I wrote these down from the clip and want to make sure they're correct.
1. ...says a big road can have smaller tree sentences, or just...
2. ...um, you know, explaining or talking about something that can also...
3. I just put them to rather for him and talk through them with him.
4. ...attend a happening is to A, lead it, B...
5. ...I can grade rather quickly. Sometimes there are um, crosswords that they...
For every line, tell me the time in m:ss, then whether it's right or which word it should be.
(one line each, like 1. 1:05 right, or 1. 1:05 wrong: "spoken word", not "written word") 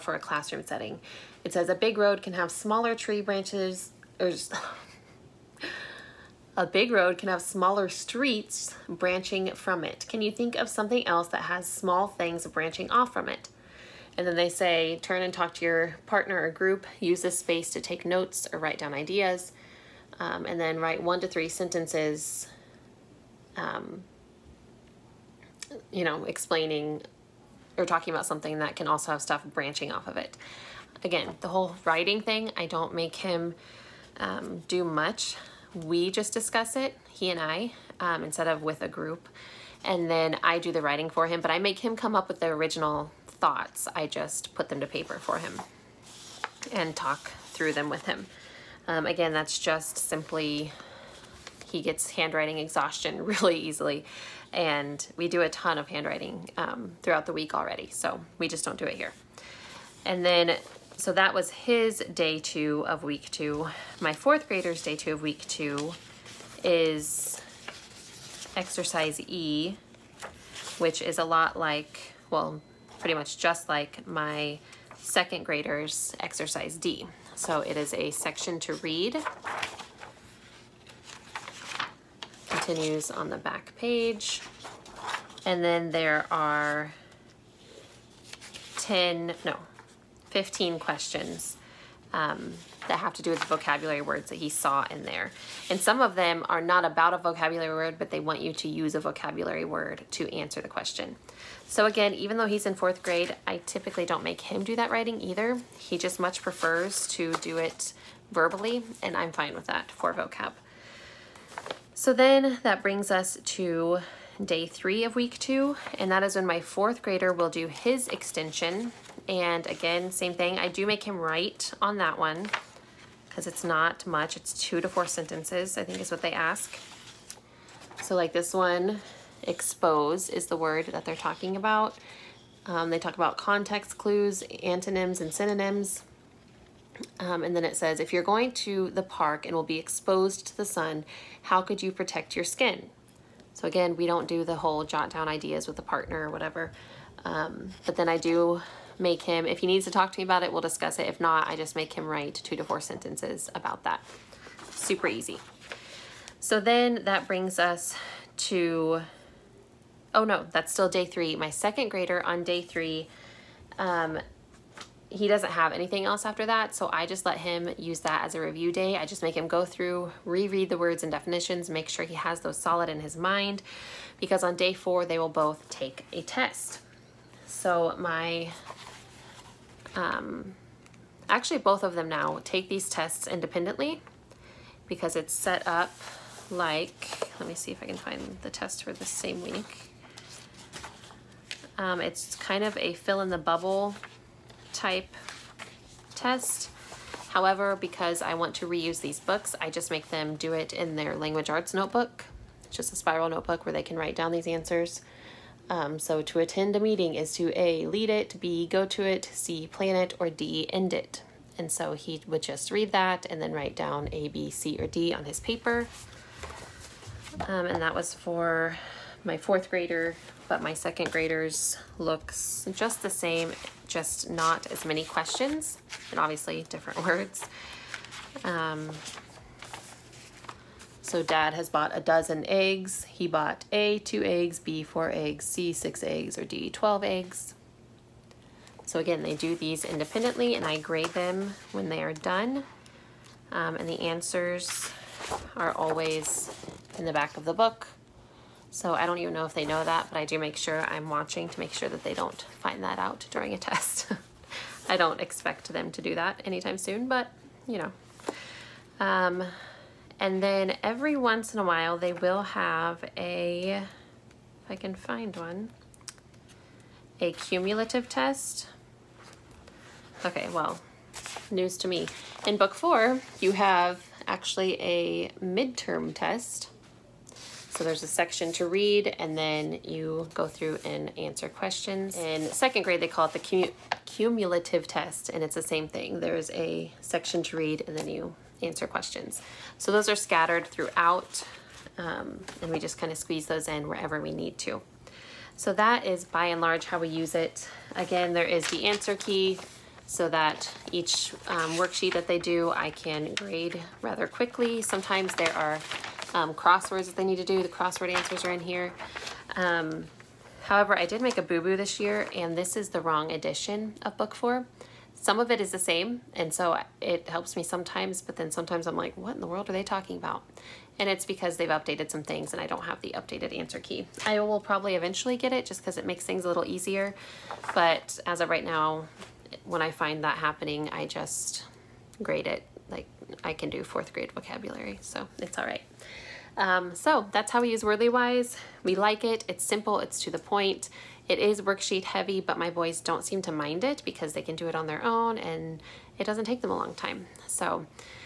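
1. 0:01 wrong: "branches", not "sentences"
2. 0:23 right
3. 0:43 wrong: "paper", not "rather"
4. 3:26 wrong: "meeting", not "happening"
5. 5:02 right.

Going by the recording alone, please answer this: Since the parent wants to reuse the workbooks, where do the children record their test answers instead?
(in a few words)
language arts notebook.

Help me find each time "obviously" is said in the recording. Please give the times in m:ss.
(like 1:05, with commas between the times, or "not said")
3:46.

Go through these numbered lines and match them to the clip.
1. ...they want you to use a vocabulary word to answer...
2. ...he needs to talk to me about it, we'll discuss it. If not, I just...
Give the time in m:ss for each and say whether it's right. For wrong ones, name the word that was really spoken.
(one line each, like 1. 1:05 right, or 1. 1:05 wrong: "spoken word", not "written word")
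1. 1:38 right
2. 2:29 right.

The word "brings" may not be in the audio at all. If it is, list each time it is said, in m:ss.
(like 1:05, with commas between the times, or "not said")
1:52, 2:37.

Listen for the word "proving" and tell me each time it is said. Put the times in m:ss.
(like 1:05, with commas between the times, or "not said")
not said.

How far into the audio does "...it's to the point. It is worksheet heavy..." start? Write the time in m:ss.
5:39.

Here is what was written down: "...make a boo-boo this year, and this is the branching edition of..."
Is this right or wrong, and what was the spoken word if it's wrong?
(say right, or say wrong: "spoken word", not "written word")
wrong: "wrong", not "branching".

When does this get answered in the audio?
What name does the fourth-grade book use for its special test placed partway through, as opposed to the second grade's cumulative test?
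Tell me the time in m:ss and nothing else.
4:35.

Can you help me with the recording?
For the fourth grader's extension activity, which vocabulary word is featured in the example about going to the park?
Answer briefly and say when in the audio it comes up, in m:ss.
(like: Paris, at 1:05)
expose, at 2:09.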